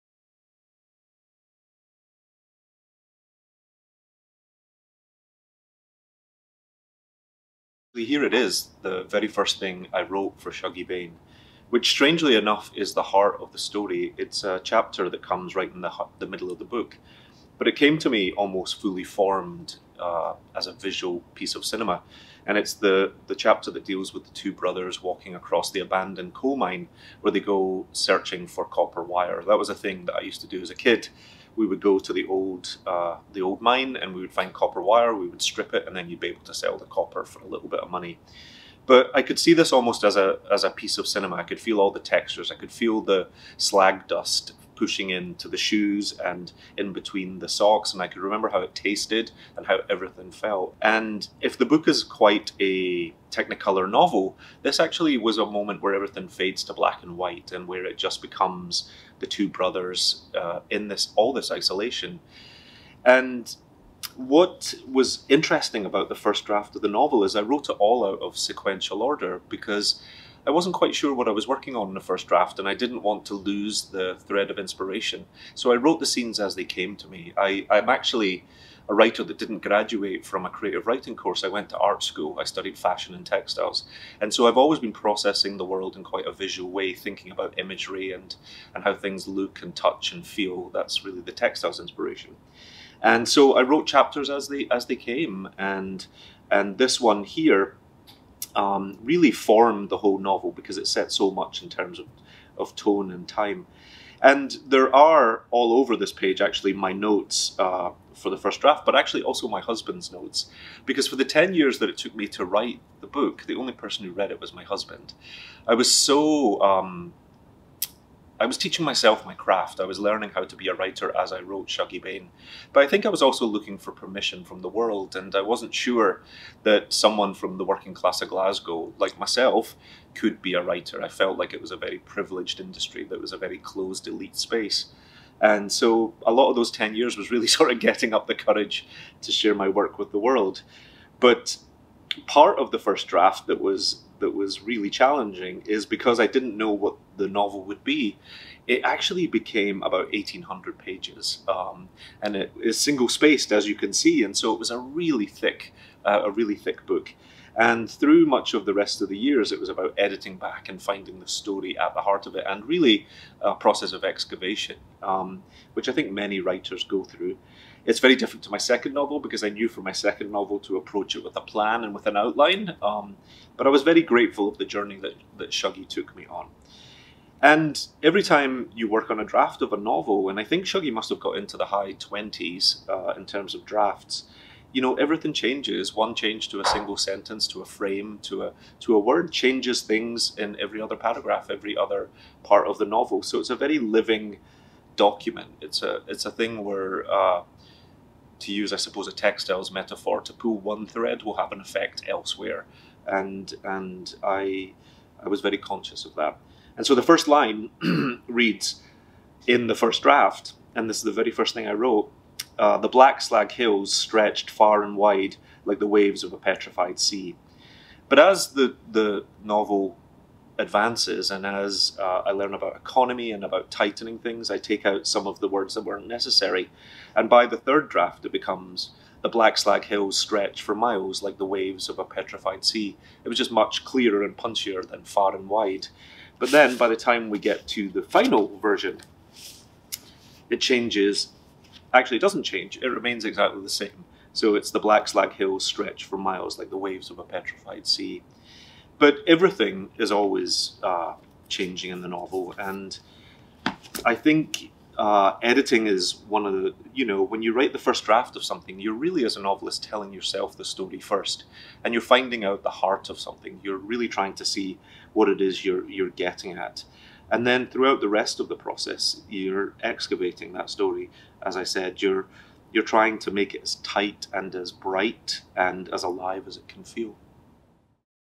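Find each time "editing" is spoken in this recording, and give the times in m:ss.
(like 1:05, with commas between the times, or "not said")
2:39, 4:15.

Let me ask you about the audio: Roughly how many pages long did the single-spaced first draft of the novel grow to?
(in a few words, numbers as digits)
1,800.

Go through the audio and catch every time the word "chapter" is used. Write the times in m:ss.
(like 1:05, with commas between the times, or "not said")
0:14, 0:23, 1:33.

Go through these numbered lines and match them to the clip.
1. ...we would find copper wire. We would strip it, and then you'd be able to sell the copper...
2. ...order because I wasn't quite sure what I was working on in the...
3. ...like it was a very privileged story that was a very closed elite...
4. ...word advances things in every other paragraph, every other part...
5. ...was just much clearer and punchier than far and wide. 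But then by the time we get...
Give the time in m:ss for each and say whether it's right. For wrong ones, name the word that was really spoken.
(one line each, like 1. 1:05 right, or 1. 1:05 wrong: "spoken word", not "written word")
1. 0:34 right
2. 1:09 right
3. 2:11 wrong: "industry", not "story"
4. 3:08 wrong: "changes", not "advances"
5. 3:53 right.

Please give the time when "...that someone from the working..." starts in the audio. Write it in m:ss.
2:06.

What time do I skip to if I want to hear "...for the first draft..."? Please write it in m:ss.
1:48.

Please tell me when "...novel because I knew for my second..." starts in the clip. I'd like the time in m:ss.
2:48.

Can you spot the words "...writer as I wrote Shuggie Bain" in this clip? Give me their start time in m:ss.
2:00.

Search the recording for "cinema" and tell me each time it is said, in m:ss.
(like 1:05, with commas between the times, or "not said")
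0:21, 0:41.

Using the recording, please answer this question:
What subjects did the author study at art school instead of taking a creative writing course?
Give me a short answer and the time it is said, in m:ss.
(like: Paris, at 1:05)
Fashion and textiles, at 1:22.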